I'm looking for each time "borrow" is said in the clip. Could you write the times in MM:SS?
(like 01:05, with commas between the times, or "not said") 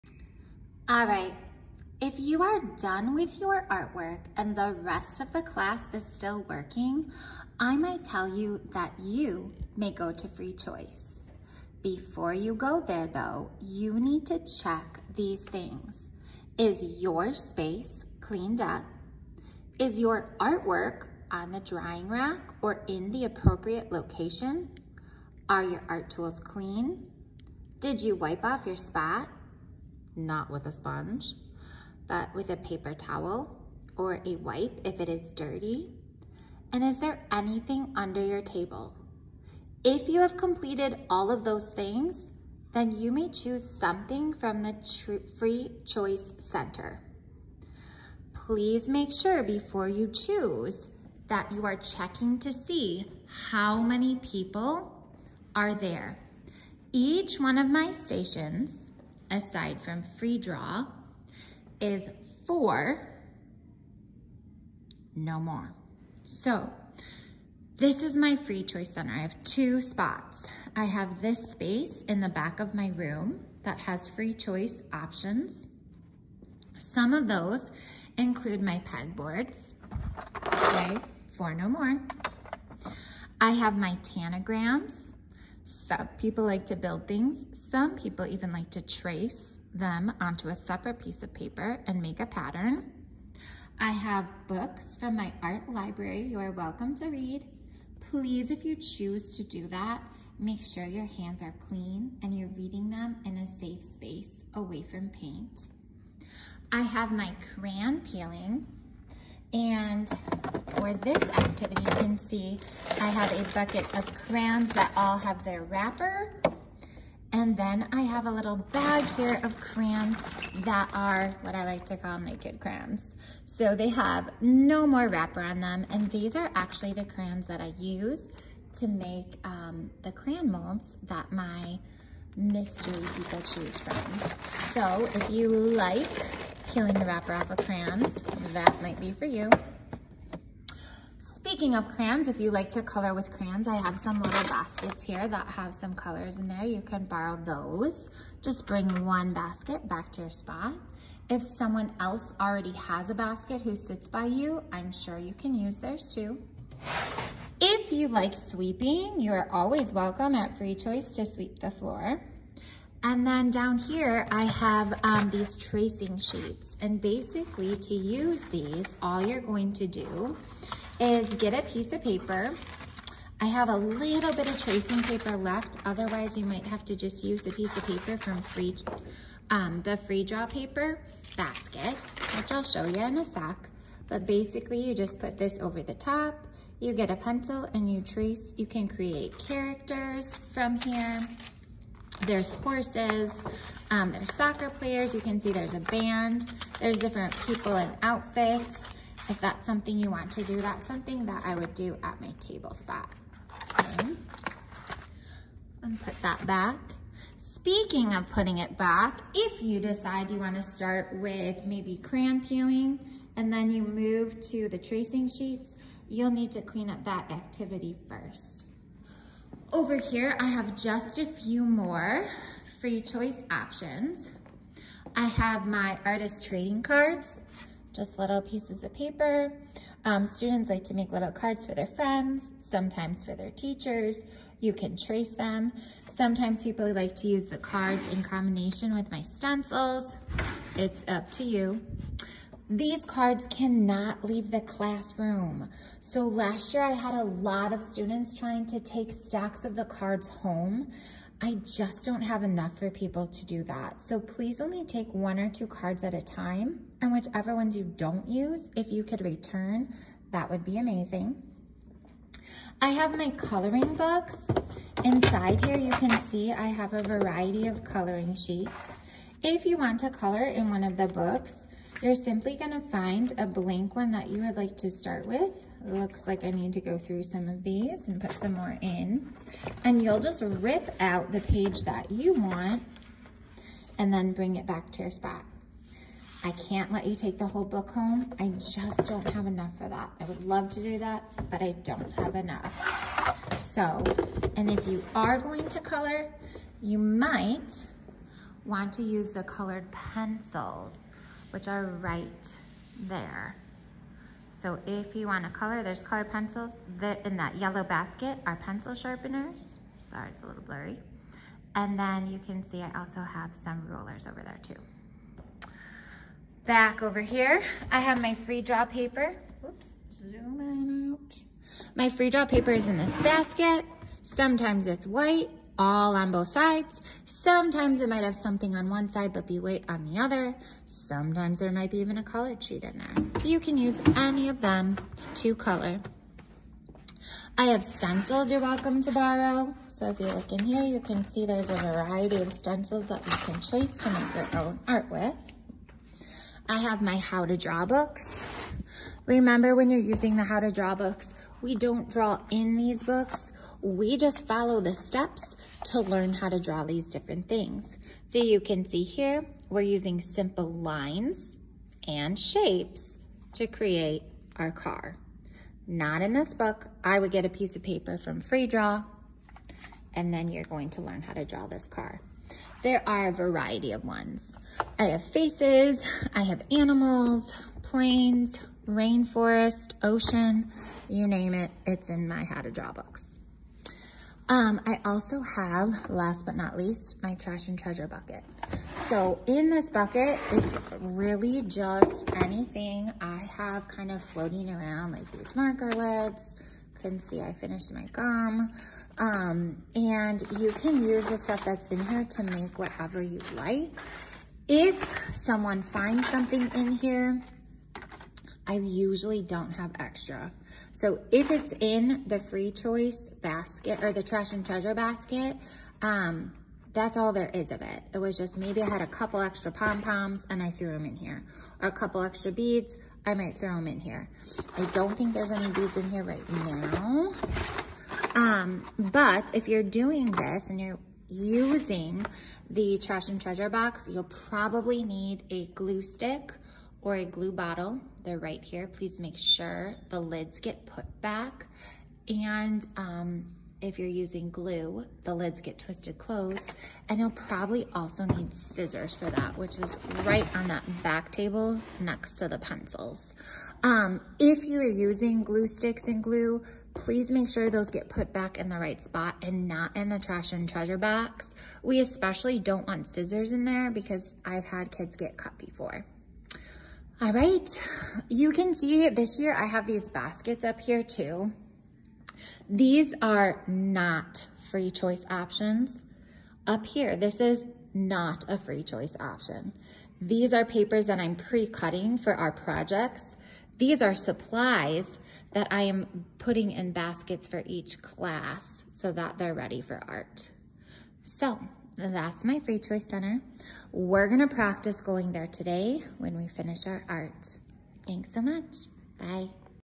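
02:27, 05:39.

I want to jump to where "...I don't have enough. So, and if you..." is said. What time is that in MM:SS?
04:51.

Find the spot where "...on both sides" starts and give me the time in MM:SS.
05:26.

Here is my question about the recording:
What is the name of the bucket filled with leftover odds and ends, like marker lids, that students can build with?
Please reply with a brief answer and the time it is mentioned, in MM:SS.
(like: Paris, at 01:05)
trash and treasure bucket, at 06:27.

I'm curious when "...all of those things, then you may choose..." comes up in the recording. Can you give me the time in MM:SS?
00:41.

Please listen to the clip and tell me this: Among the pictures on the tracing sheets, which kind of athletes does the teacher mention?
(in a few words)
soccer players.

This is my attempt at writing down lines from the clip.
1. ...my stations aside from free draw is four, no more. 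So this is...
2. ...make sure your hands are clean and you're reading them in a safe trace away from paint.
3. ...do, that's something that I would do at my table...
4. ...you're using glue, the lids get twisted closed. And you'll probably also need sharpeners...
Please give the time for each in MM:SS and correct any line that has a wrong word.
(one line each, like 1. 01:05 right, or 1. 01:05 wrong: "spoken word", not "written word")
1. 00:57 right
2. 01:40 wrong: "space", not "trace"
3. 03:20 right
4. 07:23 wrong: "scissors", not "sharpeners".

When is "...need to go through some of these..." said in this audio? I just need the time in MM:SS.
04:36.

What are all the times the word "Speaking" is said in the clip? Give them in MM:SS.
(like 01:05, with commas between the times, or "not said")
02:21, 03:27.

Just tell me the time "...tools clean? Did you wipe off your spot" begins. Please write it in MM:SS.
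00:26.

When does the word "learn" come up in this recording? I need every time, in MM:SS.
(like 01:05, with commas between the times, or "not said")
05:56, 06:11.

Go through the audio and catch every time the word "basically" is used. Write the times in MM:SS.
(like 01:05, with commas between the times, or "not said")
02:47, 03:04.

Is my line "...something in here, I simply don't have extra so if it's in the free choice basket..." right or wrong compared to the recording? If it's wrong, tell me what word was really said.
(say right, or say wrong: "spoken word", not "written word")
wrong: "usually", not "simply".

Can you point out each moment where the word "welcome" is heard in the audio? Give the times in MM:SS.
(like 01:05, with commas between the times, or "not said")
01:36, 02:39, 05:38.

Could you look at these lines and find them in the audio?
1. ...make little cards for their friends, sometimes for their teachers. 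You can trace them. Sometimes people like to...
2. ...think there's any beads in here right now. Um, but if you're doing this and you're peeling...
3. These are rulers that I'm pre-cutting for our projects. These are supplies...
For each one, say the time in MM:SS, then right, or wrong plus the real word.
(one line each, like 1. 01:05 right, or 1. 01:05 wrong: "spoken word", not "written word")
1. 03:50 right
2. 07:05 wrong: "using", not "peeling"
3. 08:00 wrong: "papers", not "rulers".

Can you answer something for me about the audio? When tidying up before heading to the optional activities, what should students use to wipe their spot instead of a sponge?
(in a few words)
paper towel.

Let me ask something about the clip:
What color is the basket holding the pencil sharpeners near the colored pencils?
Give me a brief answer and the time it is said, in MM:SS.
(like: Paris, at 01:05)
yellow, at 05:07.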